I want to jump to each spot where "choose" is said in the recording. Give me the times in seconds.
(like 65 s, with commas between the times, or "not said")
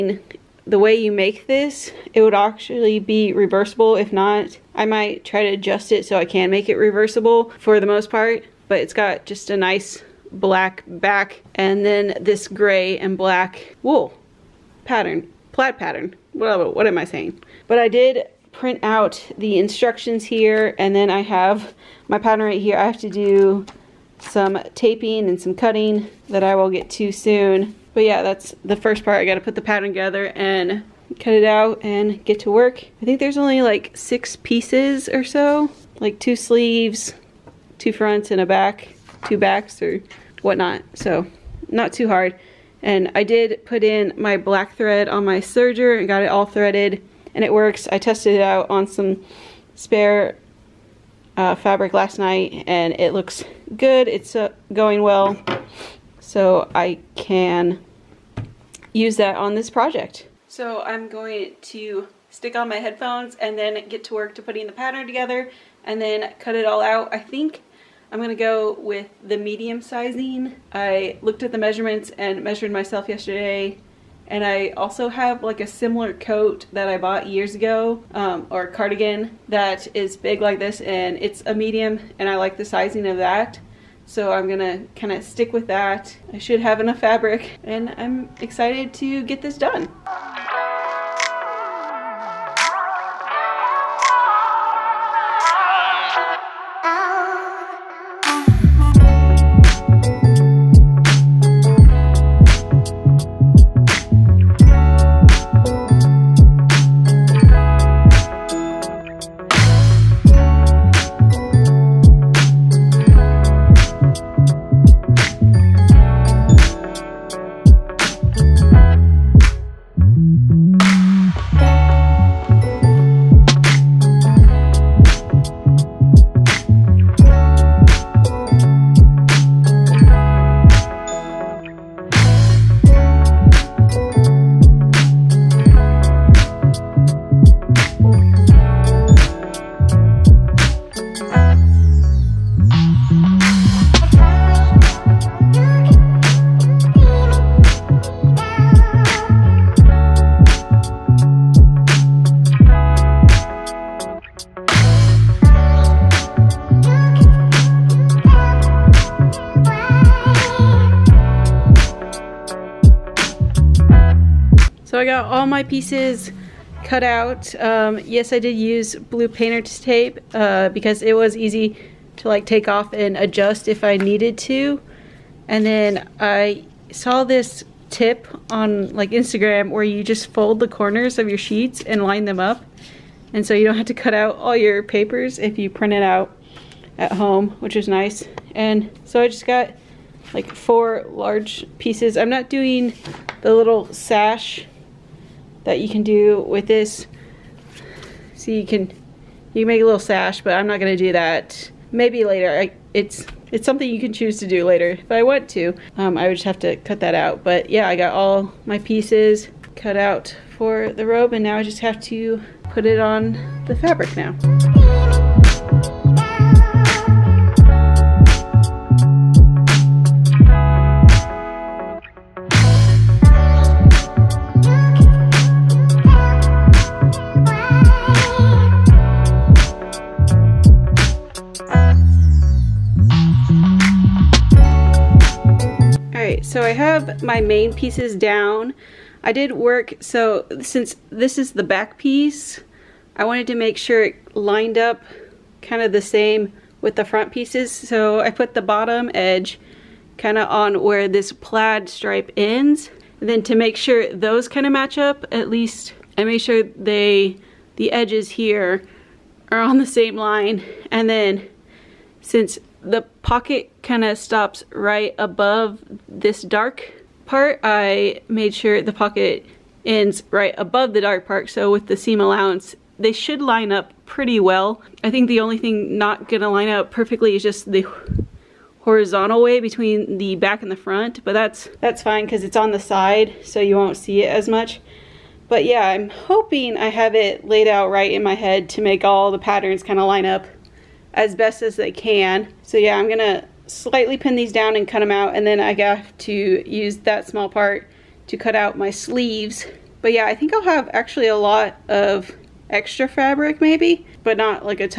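204 s.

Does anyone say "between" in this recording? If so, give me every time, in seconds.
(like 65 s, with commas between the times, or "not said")
279 s.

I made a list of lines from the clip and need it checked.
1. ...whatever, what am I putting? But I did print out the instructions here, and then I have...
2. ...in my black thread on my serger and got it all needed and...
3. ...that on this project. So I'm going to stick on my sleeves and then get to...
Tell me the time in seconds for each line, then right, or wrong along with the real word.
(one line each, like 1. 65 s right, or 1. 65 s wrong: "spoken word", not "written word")
1. 16 s wrong: "saying", not "putting"
2. 43 s wrong: "threaded", not "needed"
3. 59 s wrong: "headphones", not "sleeves".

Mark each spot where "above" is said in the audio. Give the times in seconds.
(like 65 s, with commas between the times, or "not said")
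265 s, 270 s.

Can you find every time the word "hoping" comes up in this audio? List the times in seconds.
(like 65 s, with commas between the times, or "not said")
286 s.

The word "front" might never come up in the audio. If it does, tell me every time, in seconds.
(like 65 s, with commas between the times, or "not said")
37 s, 247 s, 280 s.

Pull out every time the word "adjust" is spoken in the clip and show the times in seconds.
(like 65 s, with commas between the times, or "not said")
5 s, 173 s.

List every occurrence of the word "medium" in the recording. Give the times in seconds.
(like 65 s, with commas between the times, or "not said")
69 s, 81 s.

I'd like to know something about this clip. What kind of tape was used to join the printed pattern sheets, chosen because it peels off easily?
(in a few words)
Blue painter's tape.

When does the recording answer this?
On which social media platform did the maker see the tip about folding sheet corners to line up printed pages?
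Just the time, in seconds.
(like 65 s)
179 s.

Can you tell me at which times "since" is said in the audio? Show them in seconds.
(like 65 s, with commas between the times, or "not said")
240 s, 262 s.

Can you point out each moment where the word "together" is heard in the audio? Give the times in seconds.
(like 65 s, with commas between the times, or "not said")
29 s, 65 s.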